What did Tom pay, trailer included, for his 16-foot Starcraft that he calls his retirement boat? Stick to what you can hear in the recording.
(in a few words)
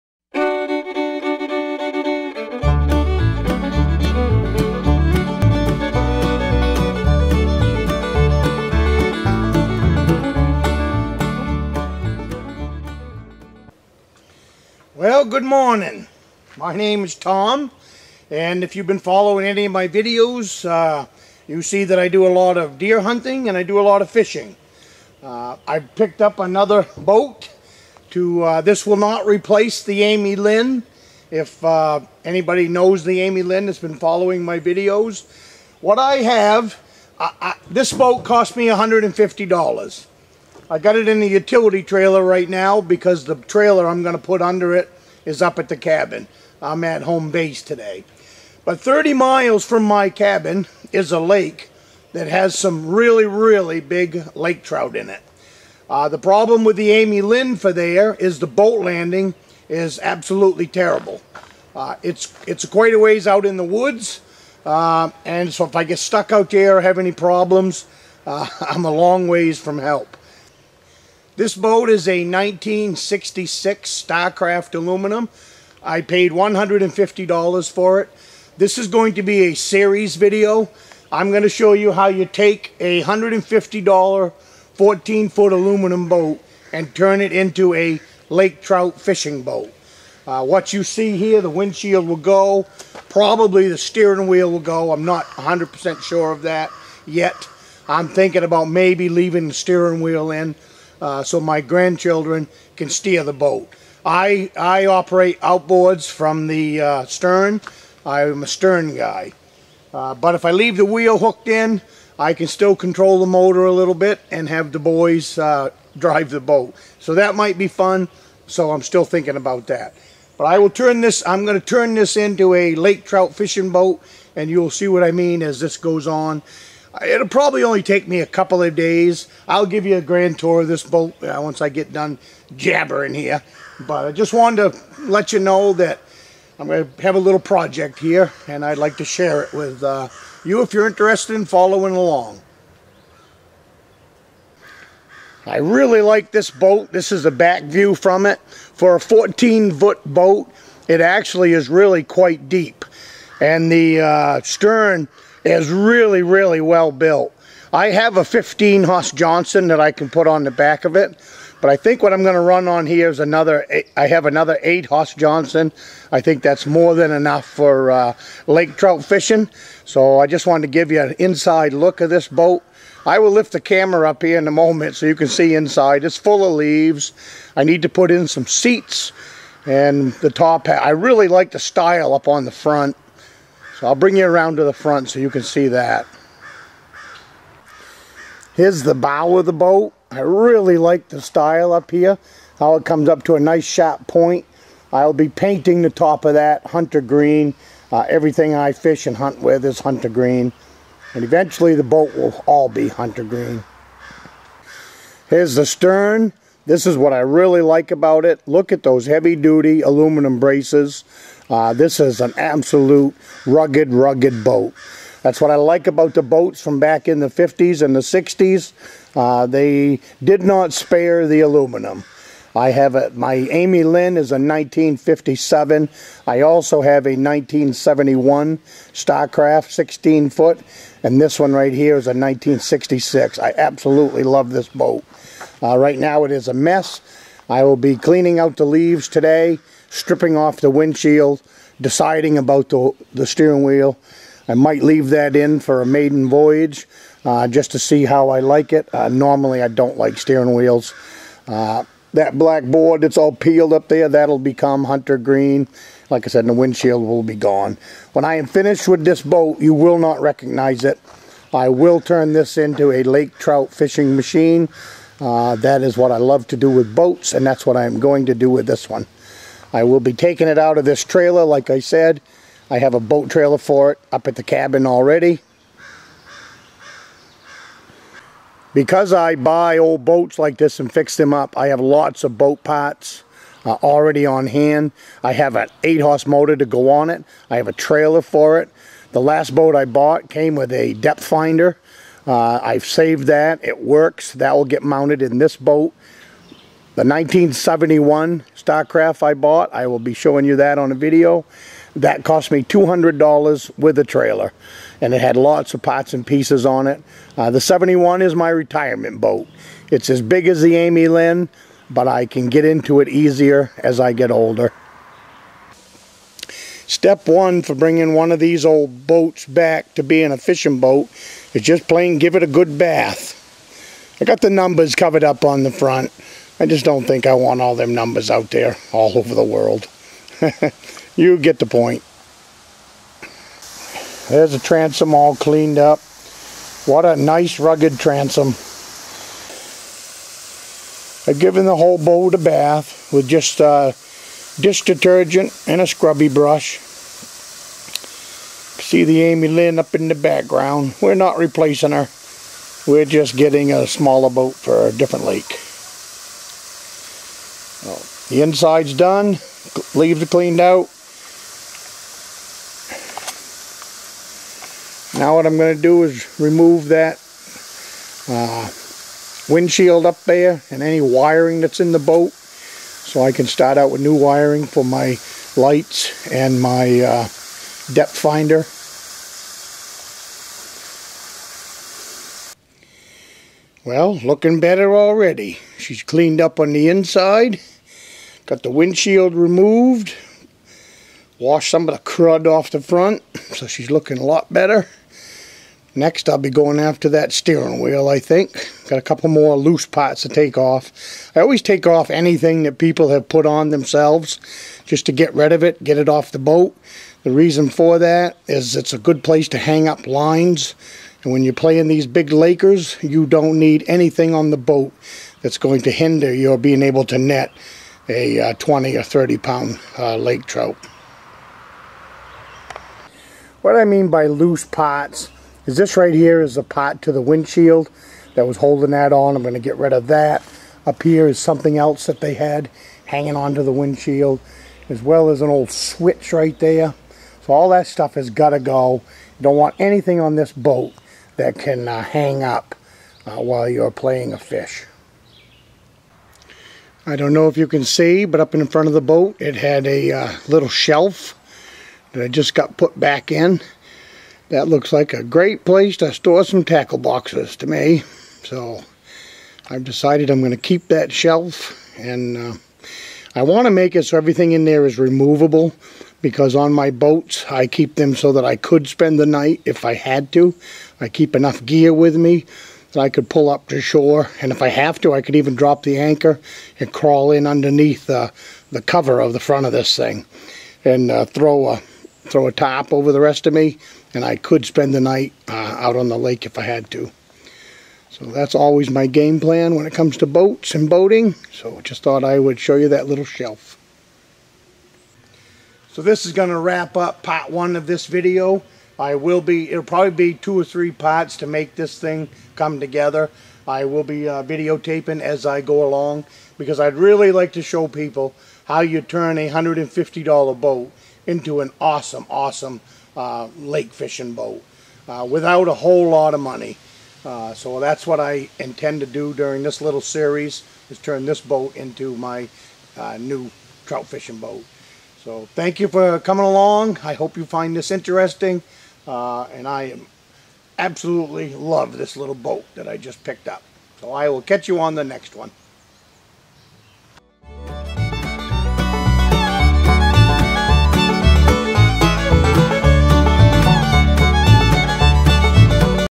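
$200.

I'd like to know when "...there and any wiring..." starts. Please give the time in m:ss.
6:10.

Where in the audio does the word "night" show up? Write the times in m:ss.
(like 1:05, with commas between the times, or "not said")
7:49, 8:05.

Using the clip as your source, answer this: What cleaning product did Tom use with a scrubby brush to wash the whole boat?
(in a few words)
Dish detergent.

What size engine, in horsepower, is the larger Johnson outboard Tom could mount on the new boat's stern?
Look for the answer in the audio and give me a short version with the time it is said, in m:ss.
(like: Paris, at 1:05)
15, at 2:38.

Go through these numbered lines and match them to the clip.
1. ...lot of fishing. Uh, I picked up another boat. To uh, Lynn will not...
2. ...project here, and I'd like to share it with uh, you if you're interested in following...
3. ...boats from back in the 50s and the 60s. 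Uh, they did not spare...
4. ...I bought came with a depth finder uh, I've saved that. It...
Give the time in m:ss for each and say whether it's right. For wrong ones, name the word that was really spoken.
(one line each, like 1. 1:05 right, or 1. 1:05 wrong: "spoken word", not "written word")
1. 0:23 wrong: "This", not "Lynn"
2. 2:17 right
3. 3:36 right
4. 4:49 right.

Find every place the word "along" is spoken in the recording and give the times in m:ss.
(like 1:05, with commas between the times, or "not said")
2:21, 8:25, 8:46.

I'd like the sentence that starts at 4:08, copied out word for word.
Uh, normally I don't like steering wheels.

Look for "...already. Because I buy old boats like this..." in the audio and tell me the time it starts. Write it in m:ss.
4:34.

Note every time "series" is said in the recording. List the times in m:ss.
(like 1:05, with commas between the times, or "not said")
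1:19, 8:40.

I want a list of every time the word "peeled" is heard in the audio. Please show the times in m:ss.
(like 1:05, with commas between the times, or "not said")
4:13.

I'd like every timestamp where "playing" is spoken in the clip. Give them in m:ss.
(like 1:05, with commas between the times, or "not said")
6:51, 7:23.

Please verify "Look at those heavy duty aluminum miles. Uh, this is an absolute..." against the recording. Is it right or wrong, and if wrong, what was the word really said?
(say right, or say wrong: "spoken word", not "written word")
wrong: "braces", not "miles".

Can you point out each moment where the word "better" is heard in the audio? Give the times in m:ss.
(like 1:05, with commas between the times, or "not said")
6:24, 6:34.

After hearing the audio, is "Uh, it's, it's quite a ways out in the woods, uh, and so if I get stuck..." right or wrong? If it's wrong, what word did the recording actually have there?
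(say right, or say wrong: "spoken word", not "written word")
right.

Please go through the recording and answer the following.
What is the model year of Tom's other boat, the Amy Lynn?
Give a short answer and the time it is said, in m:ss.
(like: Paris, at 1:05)
1957, at 3:44.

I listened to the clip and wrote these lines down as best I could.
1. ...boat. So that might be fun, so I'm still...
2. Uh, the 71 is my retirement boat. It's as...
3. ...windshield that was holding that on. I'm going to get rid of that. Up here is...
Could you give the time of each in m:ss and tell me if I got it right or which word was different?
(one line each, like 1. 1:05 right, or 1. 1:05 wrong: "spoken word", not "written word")
1. 1:56 right
2. 5:07 right
3. 7:07 right.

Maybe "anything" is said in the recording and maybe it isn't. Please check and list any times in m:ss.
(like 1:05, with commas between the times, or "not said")
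6:42, 6:53, 7:19.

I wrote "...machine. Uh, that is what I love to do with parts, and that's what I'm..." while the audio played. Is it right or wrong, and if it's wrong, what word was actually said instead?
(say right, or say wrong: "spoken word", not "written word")
wrong: "boats", not "parts".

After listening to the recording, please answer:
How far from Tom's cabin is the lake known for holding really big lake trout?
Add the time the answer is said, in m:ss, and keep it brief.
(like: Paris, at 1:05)
30 miles, at 0:48.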